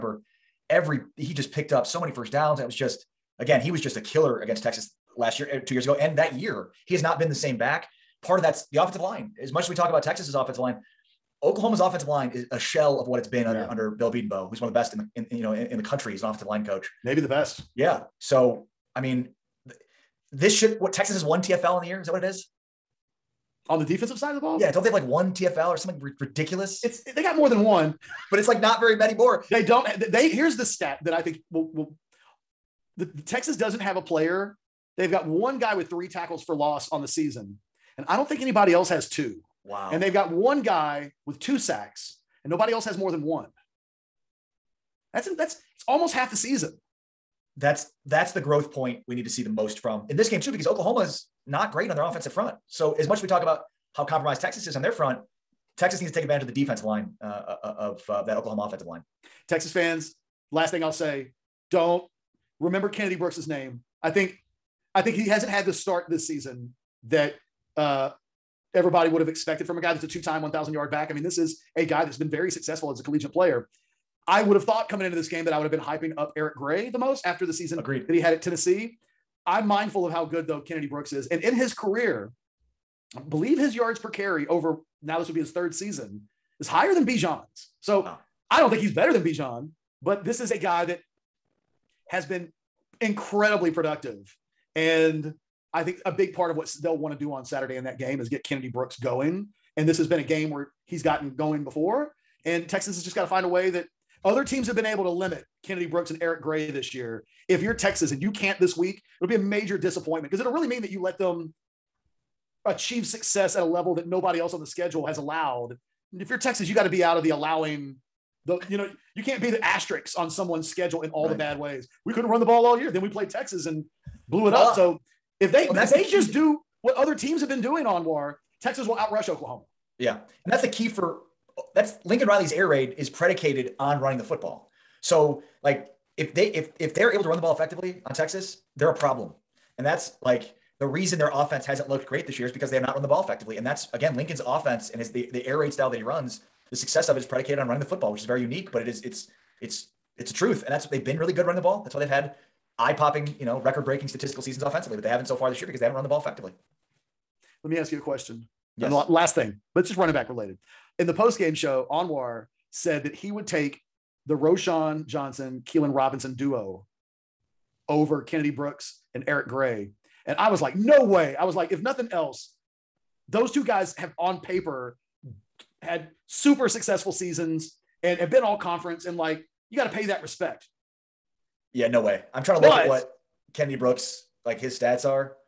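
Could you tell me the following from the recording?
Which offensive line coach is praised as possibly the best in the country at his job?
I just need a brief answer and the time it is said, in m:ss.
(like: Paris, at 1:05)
Bill Bedenbaugh, at 0:13.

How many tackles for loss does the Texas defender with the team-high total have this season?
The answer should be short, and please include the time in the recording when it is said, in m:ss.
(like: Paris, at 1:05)
3, at 0:35.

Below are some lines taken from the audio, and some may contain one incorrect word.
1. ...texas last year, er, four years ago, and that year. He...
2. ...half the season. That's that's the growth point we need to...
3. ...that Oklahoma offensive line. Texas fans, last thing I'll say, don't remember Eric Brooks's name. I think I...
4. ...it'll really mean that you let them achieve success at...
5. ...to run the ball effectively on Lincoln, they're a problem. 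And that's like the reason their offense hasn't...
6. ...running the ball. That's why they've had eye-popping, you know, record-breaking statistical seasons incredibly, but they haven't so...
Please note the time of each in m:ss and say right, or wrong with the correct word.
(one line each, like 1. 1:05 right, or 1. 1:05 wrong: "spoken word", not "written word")
1. 0:04 wrong: "two", not "four"
2. 0:46 right
3. 0:58 wrong: "Kennedy", not "Eric"
4. 1:50 right
5. 2:17 wrong: "Texas", not "Lincoln"
6. 2:31 wrong: "offensively", not "incredibly".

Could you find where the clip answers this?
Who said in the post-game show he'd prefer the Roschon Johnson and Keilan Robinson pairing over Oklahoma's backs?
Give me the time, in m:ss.
2:41.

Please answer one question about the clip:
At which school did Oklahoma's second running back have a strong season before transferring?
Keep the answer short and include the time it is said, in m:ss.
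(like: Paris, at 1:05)
Tennessee, at 1:18.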